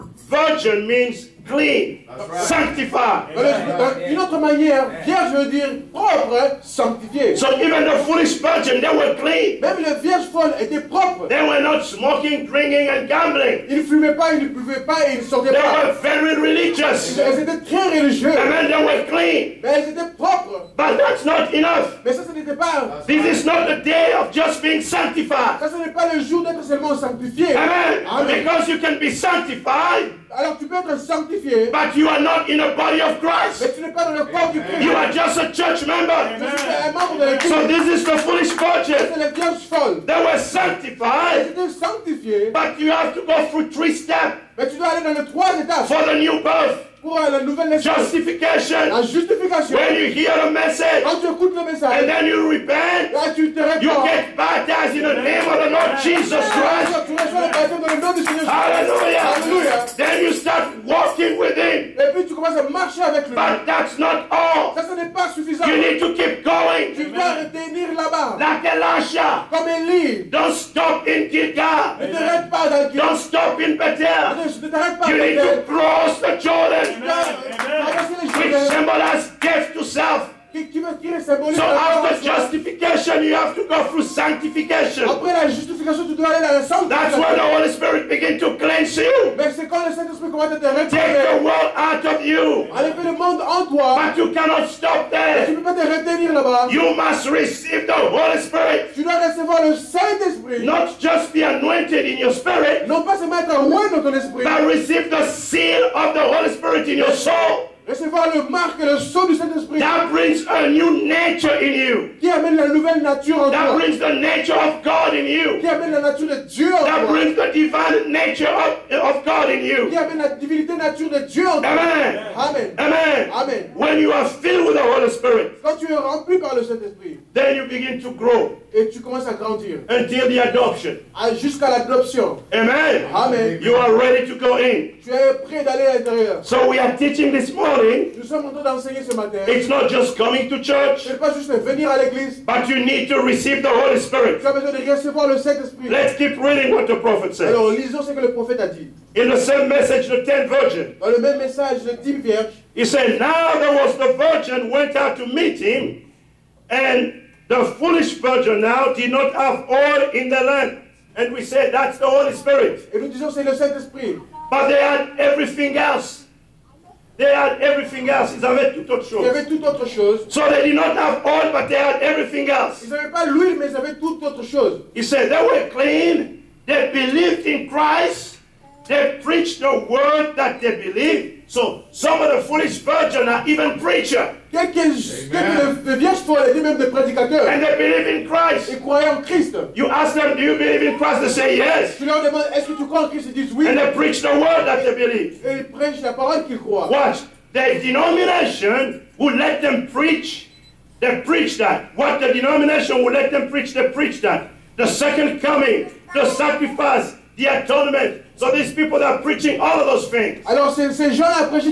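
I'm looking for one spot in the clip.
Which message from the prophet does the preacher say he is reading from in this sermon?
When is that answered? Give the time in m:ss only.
2:30.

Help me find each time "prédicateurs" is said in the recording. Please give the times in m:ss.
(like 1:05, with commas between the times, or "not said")
3:06.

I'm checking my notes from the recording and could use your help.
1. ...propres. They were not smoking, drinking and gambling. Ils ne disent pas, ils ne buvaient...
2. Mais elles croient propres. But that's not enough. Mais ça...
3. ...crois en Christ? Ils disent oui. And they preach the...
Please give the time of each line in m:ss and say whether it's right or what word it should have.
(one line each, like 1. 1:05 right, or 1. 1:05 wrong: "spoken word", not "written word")
1. 0:10 wrong: "fumaient", not "disent"
2. 0:19 wrong: "étaient", not "croient"
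3. 3:12 right.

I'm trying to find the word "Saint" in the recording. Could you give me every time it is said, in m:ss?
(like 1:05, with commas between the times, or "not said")
1:29, 1:39, 2:25, 2:43.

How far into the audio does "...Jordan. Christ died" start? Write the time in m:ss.
1:16.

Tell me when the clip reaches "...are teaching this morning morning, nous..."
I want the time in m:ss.
2:16.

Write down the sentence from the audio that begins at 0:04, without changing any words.
Une autre manière, vierge veut dire propre, sanctifié.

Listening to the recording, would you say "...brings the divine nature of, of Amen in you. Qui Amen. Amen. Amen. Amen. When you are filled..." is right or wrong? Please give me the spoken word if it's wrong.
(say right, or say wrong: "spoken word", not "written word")
wrong: "God", not "Amen".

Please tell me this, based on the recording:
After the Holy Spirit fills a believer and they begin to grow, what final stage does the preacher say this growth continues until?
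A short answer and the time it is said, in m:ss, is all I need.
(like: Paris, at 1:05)
adoption, at 2:09.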